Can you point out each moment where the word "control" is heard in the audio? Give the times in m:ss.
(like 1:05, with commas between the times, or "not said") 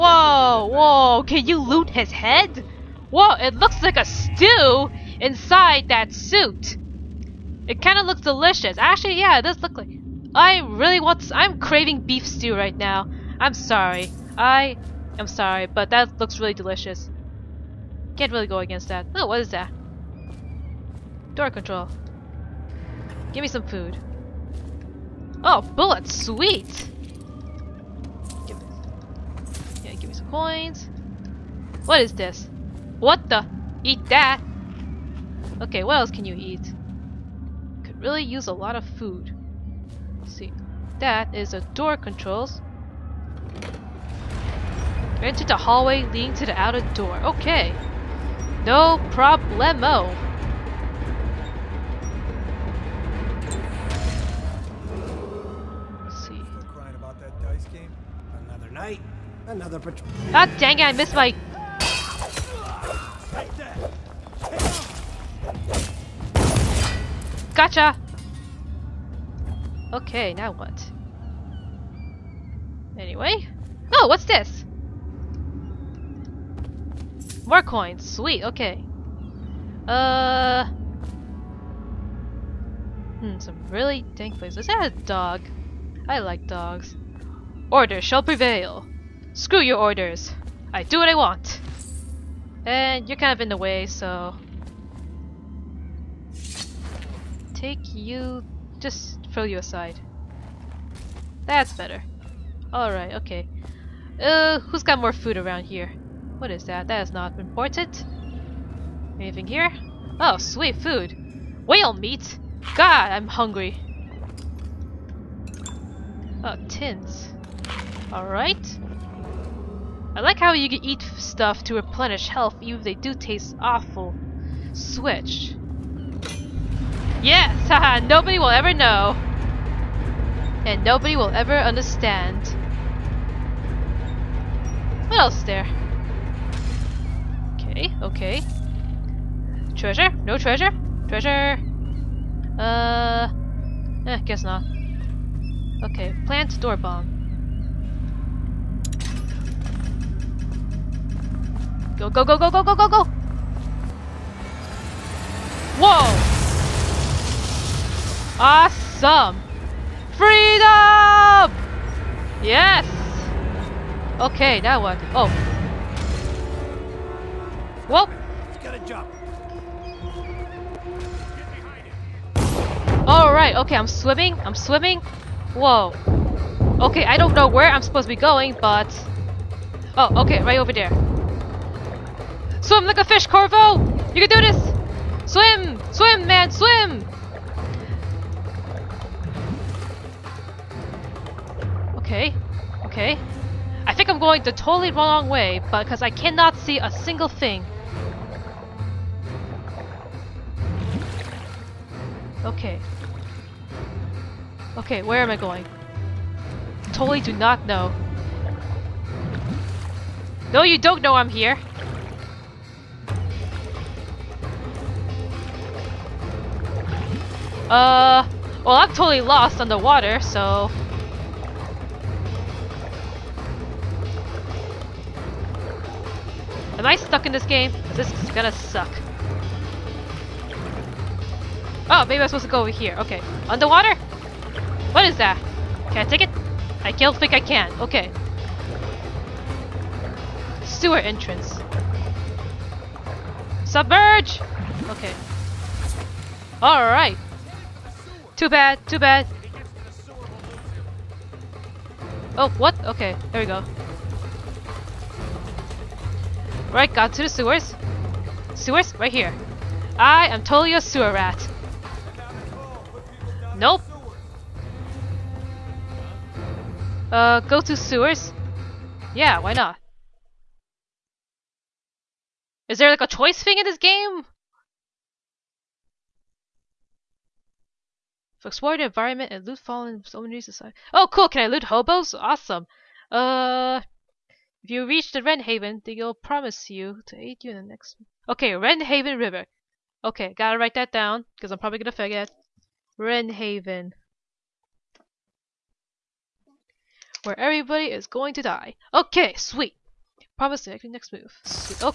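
0:21, 0:41.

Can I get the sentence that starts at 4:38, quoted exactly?
So explore the environment and loot fallen soldiers.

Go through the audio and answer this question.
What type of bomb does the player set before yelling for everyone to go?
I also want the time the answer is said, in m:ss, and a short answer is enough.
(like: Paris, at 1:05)
Door bomb, at 2:26.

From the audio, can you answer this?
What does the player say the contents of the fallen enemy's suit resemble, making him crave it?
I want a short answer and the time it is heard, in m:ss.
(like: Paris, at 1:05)
Beef stew, at 0:12.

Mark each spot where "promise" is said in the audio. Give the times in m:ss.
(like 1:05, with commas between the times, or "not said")
4:46, 5:00.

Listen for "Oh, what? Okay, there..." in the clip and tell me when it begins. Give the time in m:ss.
4:12.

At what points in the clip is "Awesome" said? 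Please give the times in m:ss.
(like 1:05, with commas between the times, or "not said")
2:38, 4:42.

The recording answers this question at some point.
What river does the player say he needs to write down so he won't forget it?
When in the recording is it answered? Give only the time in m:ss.
4:48.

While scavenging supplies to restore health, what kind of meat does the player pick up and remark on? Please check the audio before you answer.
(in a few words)
Whale meat.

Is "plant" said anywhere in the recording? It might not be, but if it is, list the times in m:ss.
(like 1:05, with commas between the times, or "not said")
2:26.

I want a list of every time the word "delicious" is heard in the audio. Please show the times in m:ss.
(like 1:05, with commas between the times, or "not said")
0:08, 0:16.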